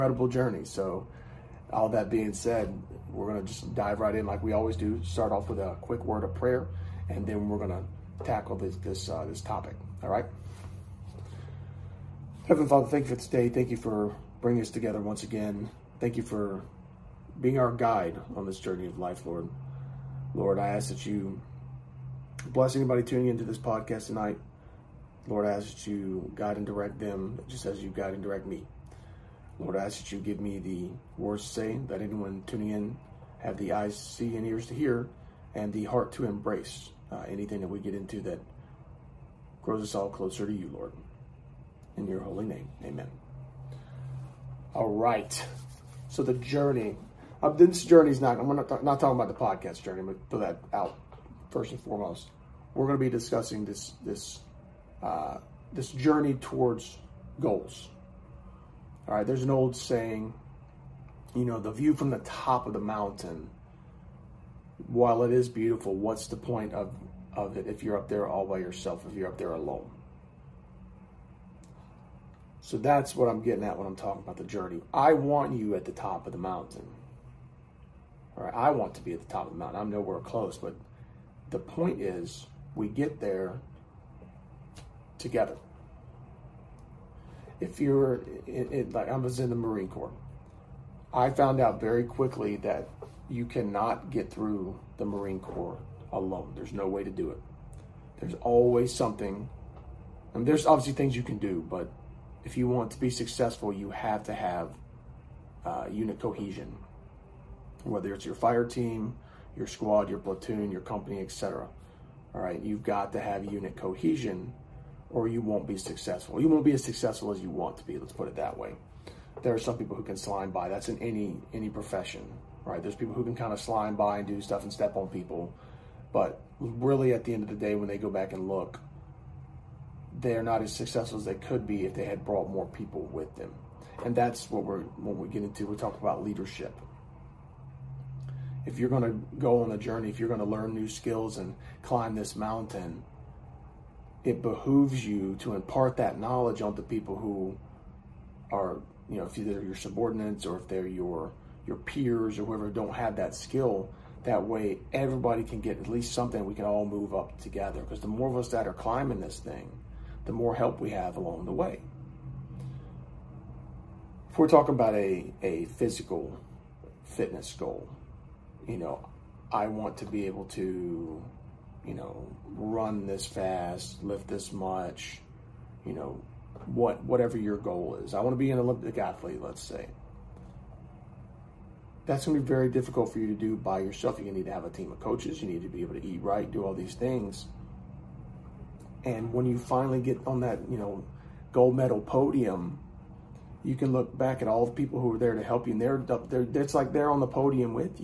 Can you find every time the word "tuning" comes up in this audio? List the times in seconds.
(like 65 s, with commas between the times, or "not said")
23 s, 32 s.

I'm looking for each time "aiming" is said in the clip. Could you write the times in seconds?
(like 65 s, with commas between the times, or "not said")
not said.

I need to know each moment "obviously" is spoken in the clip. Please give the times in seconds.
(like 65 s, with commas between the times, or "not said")
100 s.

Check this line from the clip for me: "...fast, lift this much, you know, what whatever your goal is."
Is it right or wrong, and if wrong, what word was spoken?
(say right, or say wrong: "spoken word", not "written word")
right.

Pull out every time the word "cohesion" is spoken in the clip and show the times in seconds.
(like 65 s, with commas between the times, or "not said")
106 s, 113 s.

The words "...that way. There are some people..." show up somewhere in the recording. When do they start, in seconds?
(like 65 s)
118 s.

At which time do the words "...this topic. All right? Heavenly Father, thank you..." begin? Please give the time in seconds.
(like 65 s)
9 s.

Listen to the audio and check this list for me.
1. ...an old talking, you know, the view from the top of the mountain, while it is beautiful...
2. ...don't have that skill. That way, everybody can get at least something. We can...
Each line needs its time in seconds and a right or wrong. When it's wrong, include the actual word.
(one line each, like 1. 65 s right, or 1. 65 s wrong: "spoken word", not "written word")
1. 59 s wrong: "saying", not "talking"
2. 152 s right.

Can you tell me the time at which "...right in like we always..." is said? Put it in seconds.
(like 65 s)
3 s.